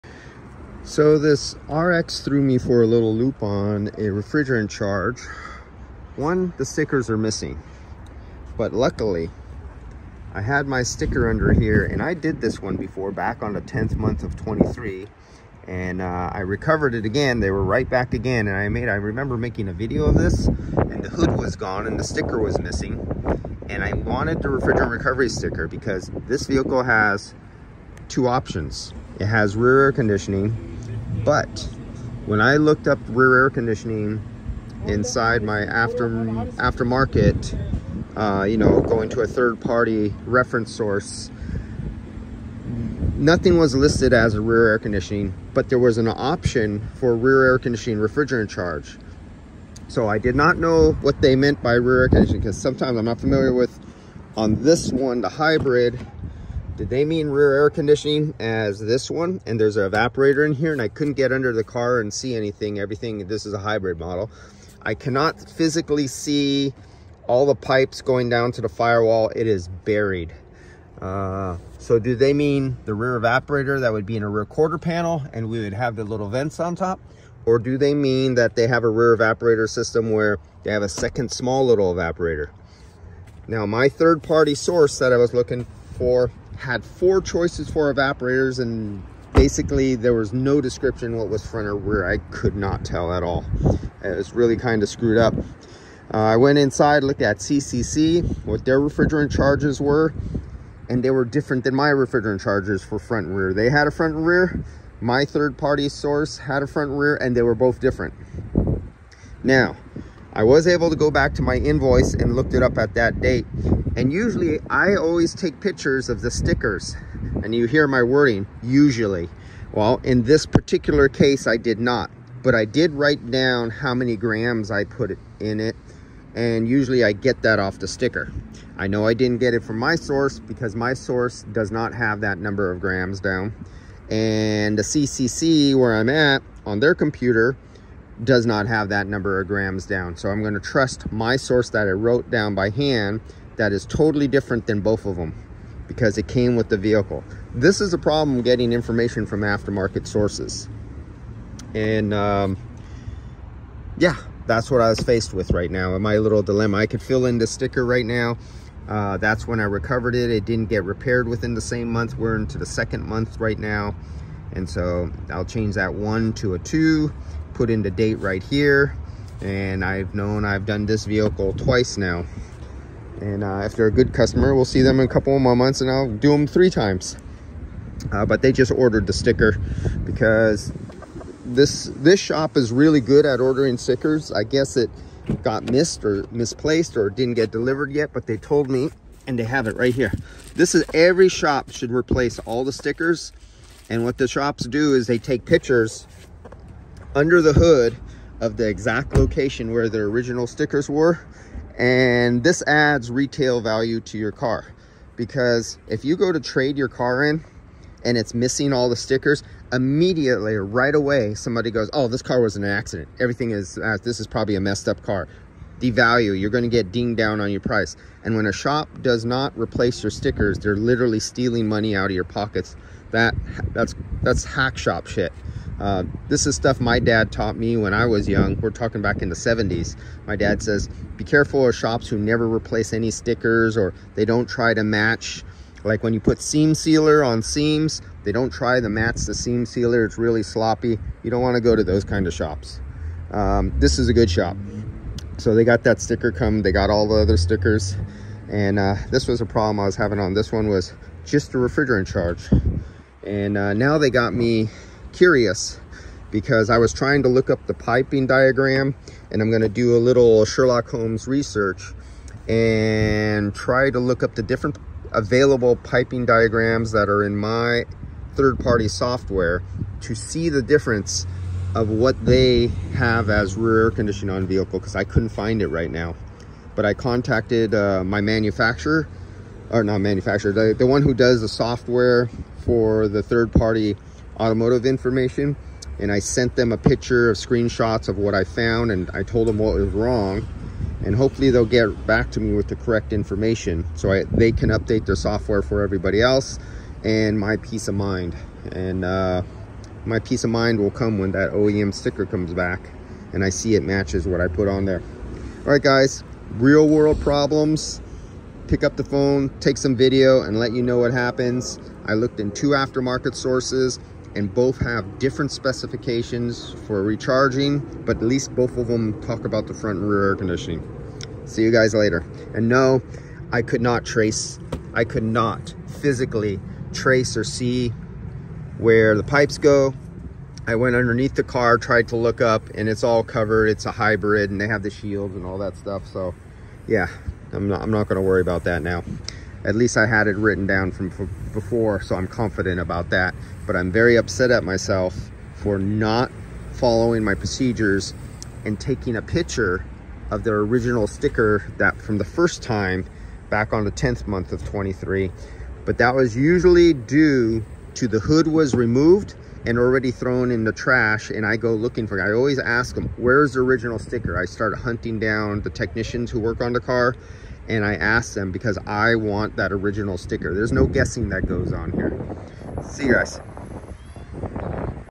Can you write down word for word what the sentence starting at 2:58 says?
Uh, but they just ordered the sticker because this this shop is really good at ordering stickers.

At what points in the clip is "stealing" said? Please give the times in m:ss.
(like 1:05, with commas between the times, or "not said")
3:41.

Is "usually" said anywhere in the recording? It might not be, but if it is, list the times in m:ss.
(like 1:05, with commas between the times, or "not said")
1:54, 1:58, 2:06, 5:56.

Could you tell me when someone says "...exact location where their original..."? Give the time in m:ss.
3:18.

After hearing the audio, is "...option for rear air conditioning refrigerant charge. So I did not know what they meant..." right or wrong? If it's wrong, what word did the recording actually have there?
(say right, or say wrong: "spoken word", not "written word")
right.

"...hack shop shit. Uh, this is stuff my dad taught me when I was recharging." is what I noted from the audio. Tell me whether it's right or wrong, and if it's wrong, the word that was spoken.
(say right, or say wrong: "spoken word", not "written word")
wrong: "young", not "recharging".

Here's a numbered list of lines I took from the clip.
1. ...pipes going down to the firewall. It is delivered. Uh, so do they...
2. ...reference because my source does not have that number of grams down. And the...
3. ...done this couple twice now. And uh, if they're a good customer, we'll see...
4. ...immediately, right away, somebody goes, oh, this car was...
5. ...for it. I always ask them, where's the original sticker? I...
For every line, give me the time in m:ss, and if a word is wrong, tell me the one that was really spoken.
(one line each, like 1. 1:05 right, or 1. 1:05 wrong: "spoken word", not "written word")
1. 1:07 wrong: "buried", not "delivered"
2. 2:09 wrong: "source", not "reference"
3. 2:50 wrong: "vehicle", not "couple"
4. 3:29 right
5. 6:02 right.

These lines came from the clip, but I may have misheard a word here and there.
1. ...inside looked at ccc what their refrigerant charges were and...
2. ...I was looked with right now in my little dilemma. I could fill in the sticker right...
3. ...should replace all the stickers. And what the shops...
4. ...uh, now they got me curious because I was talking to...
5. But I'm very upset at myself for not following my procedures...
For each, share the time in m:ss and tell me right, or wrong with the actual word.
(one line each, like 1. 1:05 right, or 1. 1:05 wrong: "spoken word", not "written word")
1. 1:36 right
2. 2:34 wrong: "faced", not "looked"
3. 3:11 right
4. 4:13 wrong: "trying", not "talking"
5. 5:43 right.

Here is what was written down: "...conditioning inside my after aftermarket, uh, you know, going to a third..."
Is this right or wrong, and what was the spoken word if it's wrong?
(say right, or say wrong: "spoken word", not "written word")
right.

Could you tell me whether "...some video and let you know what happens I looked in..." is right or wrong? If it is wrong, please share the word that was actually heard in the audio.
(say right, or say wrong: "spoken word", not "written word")
right.